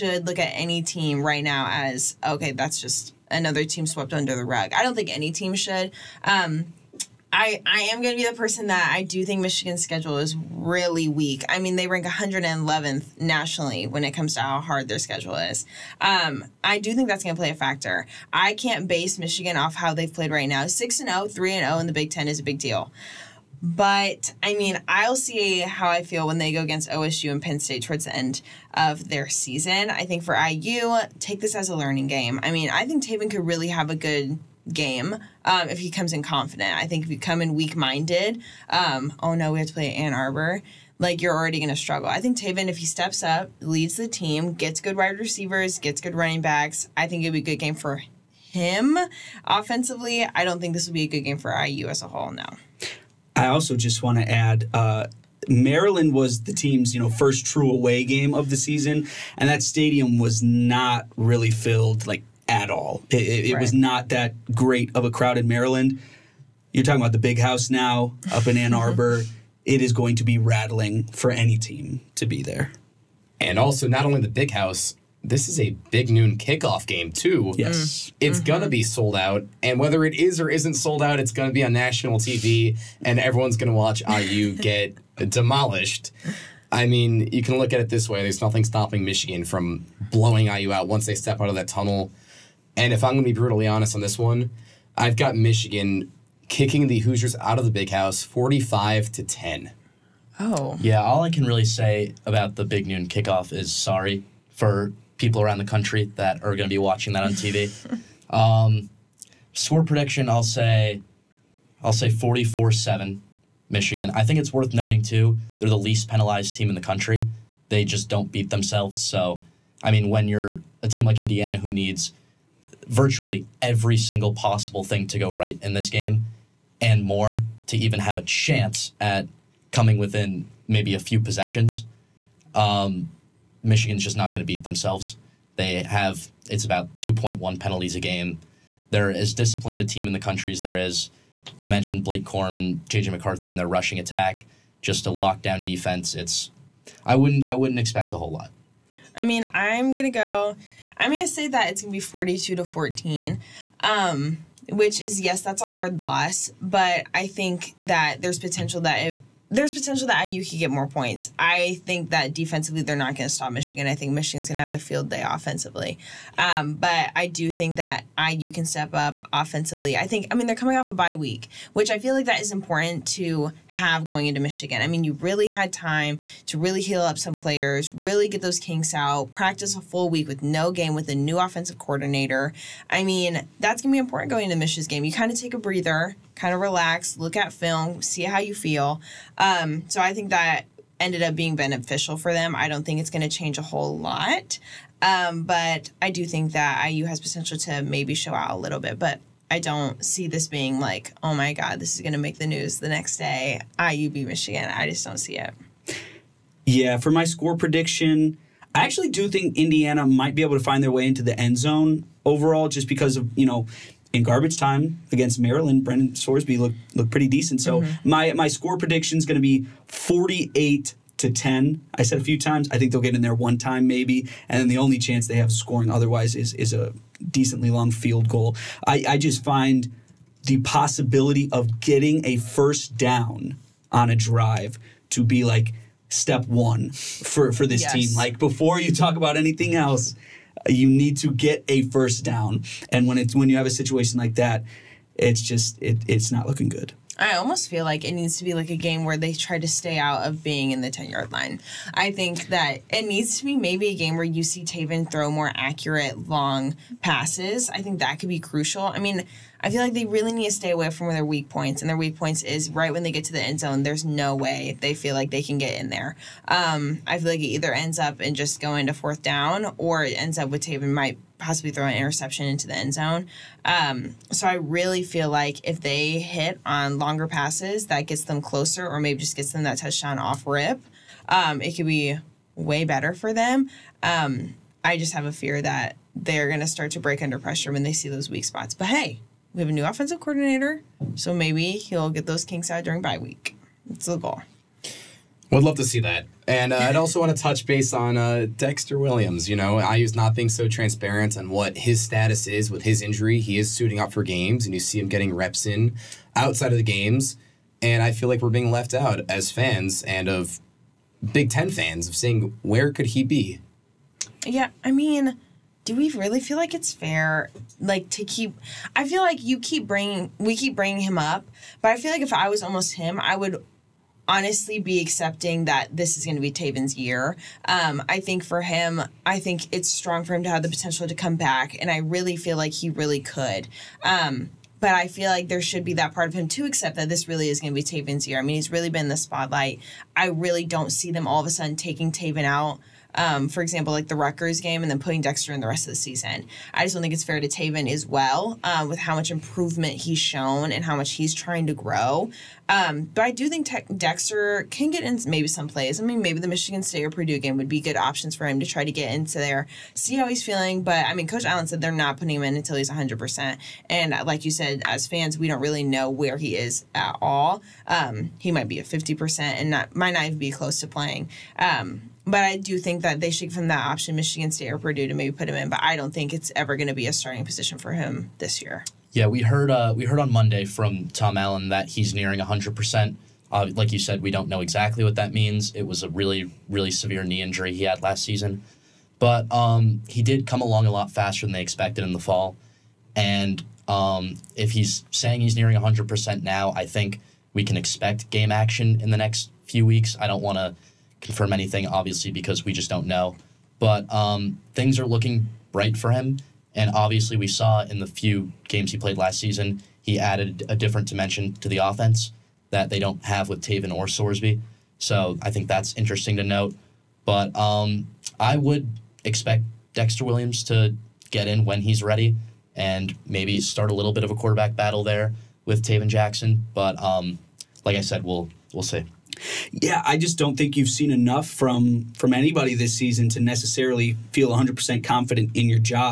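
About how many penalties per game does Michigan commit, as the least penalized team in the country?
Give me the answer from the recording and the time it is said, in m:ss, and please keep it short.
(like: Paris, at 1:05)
2.1, at 2:16.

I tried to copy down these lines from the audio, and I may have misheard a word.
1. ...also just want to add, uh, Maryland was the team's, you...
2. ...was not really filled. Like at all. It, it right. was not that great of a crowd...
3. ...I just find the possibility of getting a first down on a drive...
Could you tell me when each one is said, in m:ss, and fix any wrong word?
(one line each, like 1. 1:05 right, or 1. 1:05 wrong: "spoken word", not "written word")
1. 0:53 right
2. 1:00 right
3. 3:49 right.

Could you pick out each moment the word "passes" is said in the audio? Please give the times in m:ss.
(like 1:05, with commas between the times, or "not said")
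4:17, 4:37.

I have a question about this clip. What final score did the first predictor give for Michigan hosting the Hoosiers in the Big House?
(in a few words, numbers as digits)
45-10.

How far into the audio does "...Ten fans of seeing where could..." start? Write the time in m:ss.
5:11.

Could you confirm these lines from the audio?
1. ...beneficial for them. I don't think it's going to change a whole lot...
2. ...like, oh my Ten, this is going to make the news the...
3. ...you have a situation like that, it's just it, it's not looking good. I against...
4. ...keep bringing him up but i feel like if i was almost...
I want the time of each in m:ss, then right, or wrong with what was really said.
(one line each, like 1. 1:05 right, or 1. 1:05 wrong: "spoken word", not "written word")
1. 3:11 right
2. 3:20 wrong: "God", not "Ten"
3. 4:03 wrong: "almost", not "against"
4. 5:20 right.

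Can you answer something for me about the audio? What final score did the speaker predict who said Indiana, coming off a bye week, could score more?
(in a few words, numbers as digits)
42-14.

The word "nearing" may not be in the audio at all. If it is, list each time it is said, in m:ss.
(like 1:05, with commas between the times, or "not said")
6:22, 6:35.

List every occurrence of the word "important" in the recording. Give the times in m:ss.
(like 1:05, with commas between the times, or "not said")
2:52, 3:03.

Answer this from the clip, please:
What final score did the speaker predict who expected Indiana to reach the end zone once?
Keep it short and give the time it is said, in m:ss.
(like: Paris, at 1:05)
48-10, at 3:39.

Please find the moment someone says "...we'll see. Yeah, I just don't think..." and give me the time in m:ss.
7:08.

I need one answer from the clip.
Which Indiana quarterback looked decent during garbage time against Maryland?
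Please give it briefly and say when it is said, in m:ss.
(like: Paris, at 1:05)
Brendan Sorsby, at 3:35.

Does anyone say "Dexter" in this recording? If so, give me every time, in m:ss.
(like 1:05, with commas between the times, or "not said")
4:58, 5:45, 5:53, 6:59.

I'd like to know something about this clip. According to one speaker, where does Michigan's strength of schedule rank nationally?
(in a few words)
111th.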